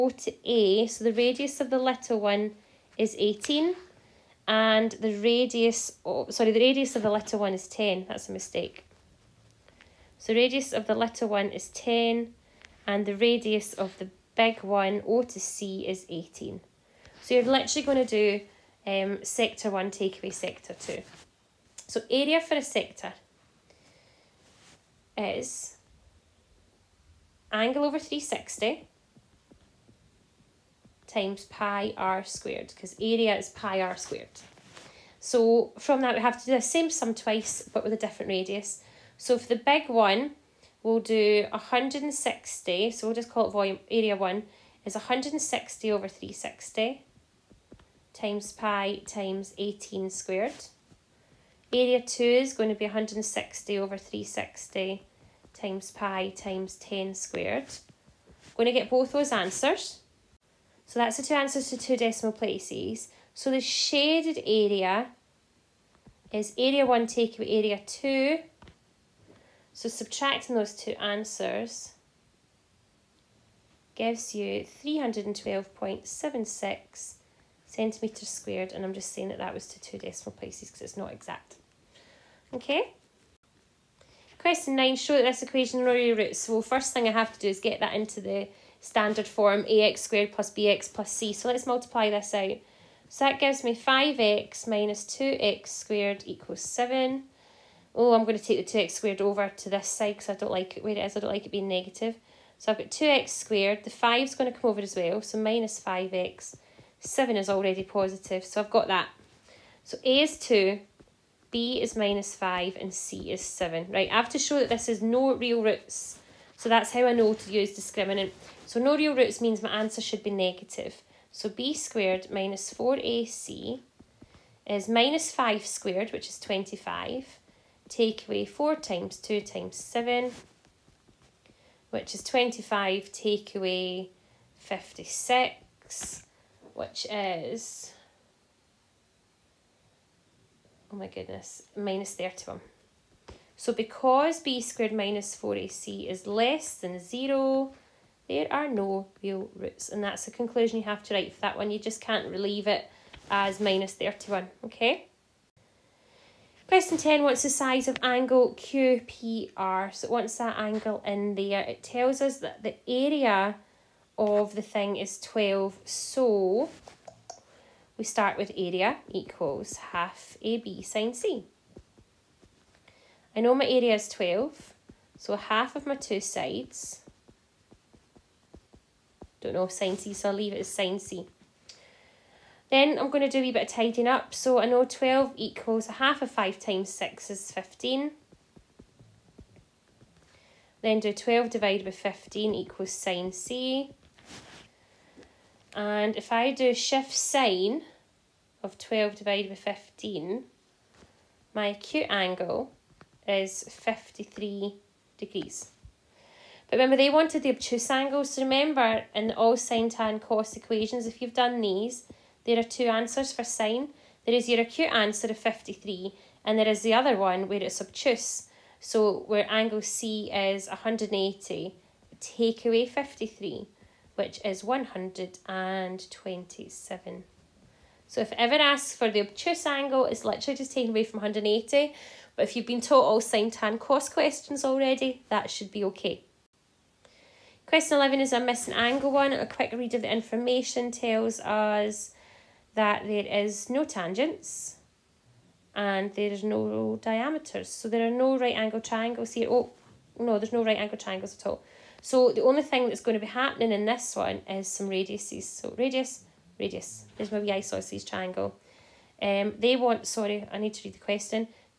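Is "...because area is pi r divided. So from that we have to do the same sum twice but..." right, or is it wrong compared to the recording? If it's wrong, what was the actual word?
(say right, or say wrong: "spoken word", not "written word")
wrong: "squared", not "divided".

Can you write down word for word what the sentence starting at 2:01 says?
So B squared minus 4AC is minus 5 squared, which is 25.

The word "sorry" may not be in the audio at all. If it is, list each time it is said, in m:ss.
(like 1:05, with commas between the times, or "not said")
0:06, 4:20.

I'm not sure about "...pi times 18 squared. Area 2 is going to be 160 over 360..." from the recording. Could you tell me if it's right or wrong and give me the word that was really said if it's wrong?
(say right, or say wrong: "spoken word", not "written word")
right.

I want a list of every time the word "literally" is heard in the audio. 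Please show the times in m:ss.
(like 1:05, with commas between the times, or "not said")
0:17, 3:50.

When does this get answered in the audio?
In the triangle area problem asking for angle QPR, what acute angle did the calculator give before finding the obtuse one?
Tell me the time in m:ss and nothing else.
3:23.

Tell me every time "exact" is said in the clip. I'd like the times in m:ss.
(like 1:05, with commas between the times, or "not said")
1:21.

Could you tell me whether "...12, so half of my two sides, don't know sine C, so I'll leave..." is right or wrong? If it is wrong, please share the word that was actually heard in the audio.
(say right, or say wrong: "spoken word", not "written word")
right.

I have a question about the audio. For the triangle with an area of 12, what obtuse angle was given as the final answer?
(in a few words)
127.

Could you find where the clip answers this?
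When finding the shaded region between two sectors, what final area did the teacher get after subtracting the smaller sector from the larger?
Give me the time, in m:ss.
1:14.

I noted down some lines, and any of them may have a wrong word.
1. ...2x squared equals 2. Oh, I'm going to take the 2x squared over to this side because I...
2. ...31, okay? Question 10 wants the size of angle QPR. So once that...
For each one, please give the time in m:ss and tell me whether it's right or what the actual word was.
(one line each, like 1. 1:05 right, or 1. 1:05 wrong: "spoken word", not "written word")
1. 1:35 wrong: "7", not "2"
2. 2:33 right.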